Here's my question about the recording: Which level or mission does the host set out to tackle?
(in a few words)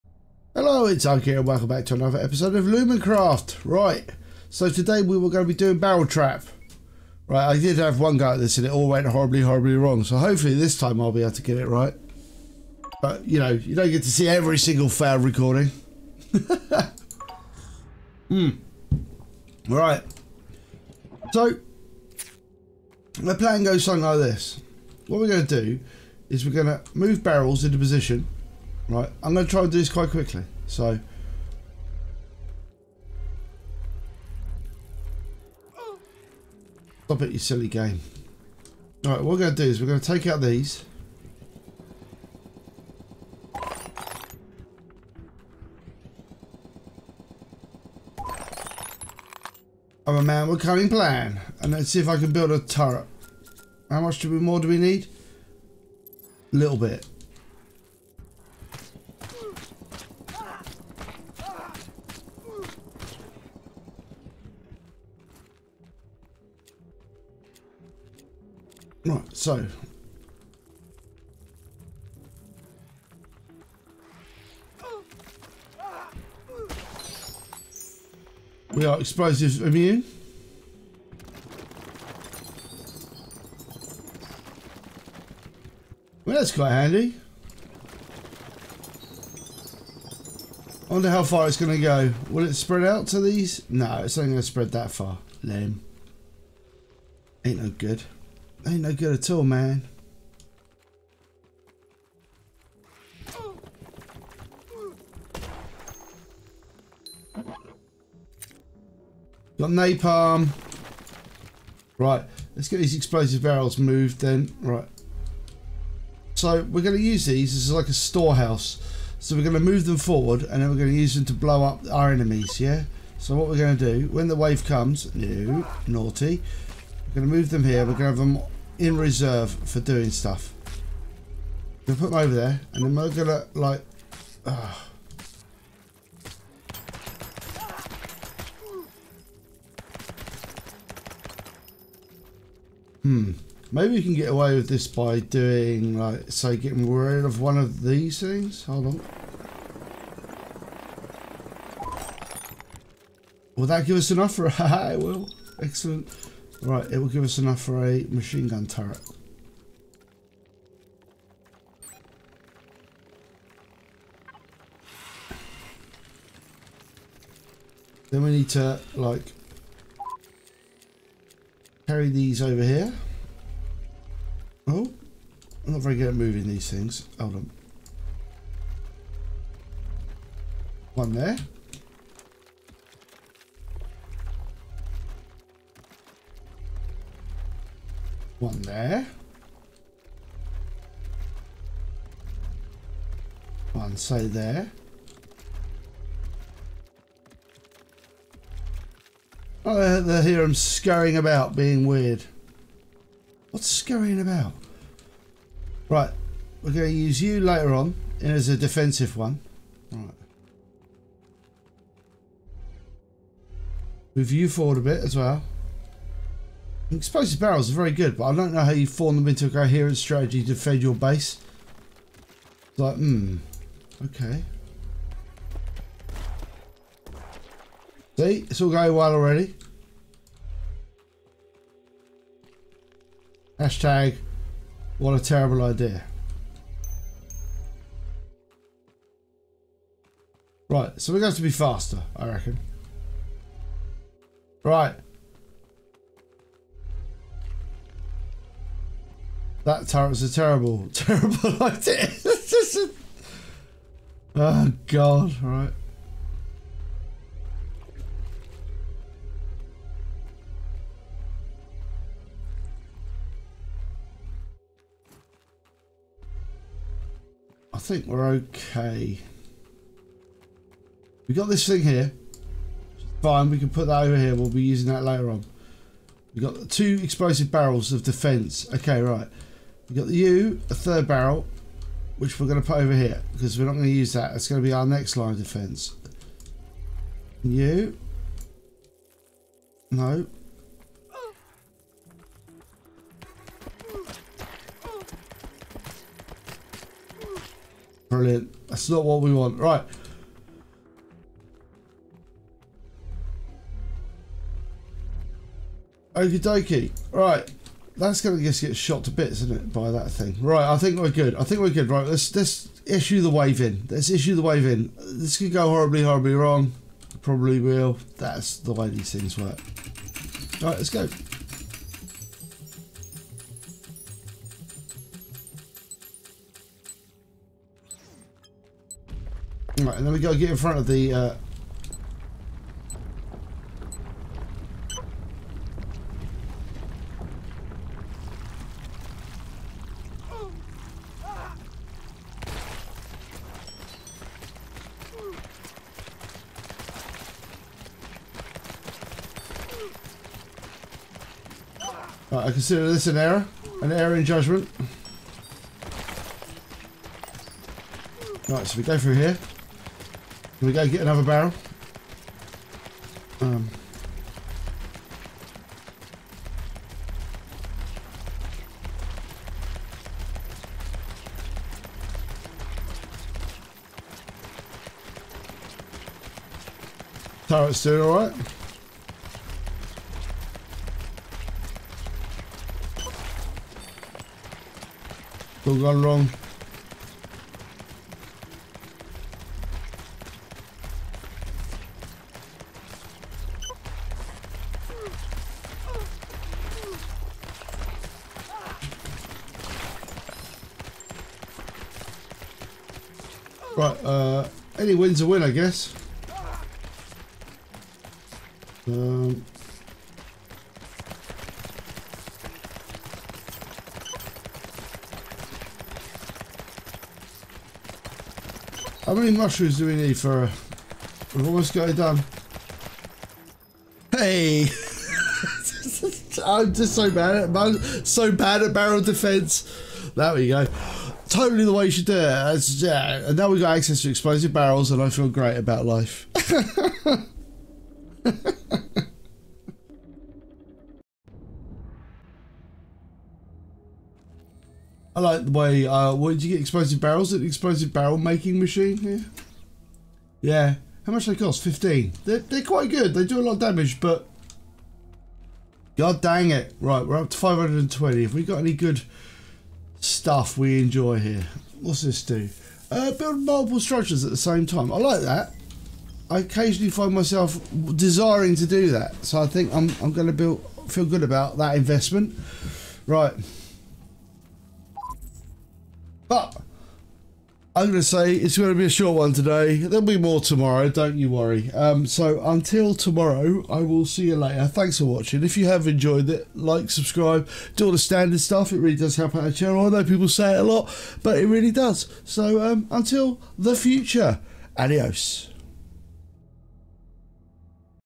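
Barrel Trap.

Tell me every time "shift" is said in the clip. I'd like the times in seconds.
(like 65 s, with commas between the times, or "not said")
not said.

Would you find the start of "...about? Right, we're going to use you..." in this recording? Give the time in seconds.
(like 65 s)
204 s.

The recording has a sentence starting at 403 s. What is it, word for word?
Right, uh, any win's a win, I guess.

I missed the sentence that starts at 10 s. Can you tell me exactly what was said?
So hopefully this time I'll be able to get it right.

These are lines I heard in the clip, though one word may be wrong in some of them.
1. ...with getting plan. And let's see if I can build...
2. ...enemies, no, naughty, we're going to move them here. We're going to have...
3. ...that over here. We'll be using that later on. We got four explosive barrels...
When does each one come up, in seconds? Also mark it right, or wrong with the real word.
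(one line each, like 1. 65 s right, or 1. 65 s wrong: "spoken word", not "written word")
1. 50 s wrong: "cunning", not "getting"
2. 124 s wrong: "comes", not "enemies"
3. 273 s wrong: "two", not "four".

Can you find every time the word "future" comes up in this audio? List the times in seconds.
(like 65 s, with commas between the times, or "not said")
493 s.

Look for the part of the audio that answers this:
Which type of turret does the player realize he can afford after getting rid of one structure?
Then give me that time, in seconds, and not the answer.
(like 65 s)
158 s.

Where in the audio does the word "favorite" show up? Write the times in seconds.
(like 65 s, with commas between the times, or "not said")
not said.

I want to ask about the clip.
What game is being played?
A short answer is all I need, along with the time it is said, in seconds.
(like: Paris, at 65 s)
Lumencraft, at 2 s.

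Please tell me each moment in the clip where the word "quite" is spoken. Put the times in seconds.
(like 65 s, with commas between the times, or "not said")
29 s, 86 s, 452 s.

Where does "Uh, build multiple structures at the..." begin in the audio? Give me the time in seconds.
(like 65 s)
462 s.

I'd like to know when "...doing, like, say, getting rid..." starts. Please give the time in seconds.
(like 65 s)
145 s.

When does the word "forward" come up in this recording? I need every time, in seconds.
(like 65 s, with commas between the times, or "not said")
119 s, 214 s.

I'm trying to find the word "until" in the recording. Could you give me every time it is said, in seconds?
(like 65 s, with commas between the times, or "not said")
482 s, 492 s.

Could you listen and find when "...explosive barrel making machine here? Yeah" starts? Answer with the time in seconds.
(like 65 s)
447 s.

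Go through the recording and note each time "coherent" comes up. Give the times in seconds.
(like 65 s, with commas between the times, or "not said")
219 s.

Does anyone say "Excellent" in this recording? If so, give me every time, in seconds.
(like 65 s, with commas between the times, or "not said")
155 s.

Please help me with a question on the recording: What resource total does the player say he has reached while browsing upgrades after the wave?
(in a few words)
520.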